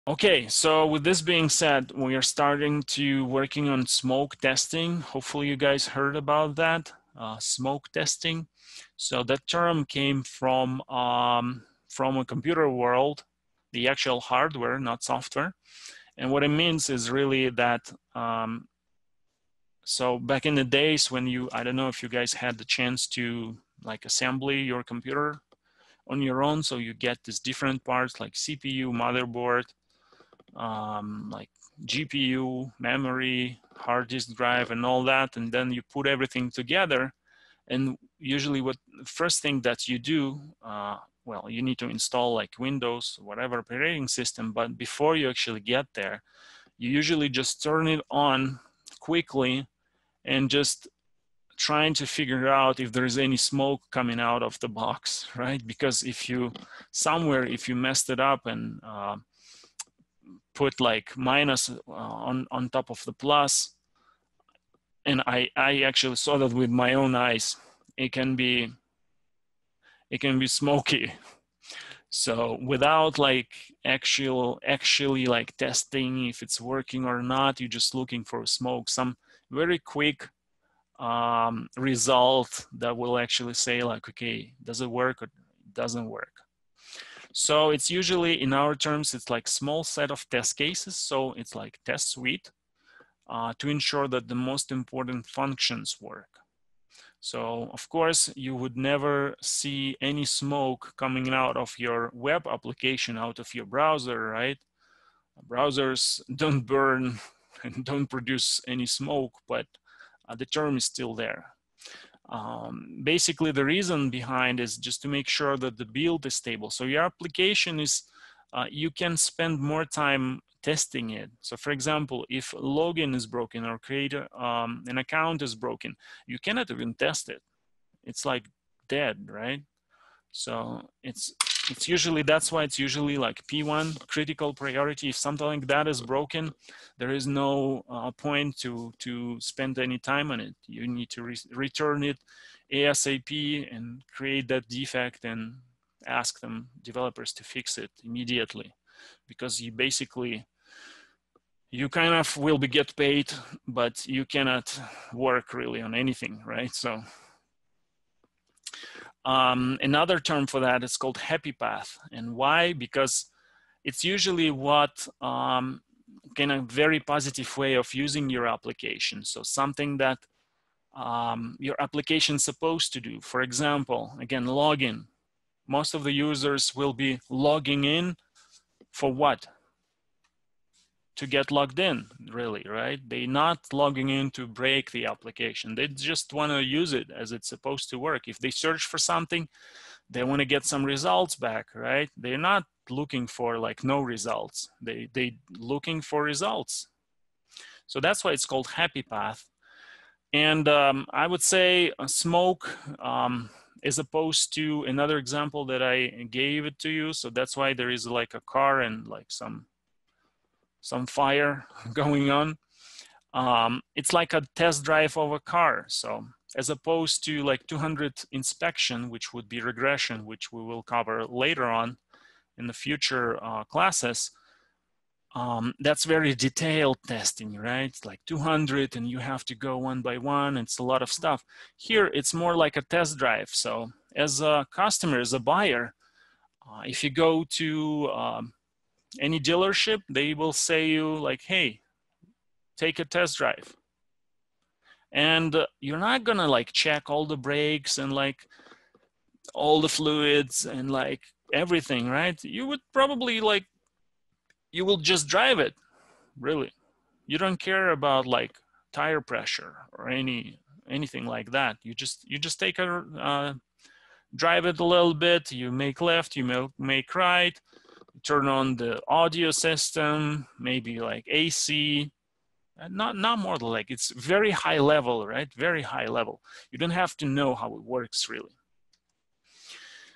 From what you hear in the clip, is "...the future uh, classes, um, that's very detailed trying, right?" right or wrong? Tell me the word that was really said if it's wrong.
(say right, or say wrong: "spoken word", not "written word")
wrong: "testing", not "trying".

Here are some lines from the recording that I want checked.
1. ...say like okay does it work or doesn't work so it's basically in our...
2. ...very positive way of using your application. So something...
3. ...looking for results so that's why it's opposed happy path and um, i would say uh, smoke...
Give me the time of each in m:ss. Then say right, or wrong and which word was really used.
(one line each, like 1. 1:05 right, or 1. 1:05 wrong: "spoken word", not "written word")
1. 1:23 wrong: "usually", not "basically"
2. 2:46 right
3. 3:15 wrong: "called", not "opposed".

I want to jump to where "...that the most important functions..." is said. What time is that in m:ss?
1:34.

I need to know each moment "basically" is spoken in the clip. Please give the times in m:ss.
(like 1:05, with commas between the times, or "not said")
1:53, 2:29.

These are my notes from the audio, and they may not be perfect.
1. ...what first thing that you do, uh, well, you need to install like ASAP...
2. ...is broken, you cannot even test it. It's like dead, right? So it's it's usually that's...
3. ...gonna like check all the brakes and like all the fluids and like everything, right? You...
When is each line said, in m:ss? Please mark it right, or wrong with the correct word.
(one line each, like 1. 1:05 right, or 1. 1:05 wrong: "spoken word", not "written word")
1. 0:38 wrong: "Windows", not "ASAP"
2. 2:05 right
3. 4:06 right.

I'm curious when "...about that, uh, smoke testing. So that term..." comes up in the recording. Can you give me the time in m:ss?
0:06.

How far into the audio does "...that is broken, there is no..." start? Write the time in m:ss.
2:15.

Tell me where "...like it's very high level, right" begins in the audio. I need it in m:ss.
4:33.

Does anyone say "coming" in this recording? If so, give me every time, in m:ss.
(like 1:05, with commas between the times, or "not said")
0:53, 1:40.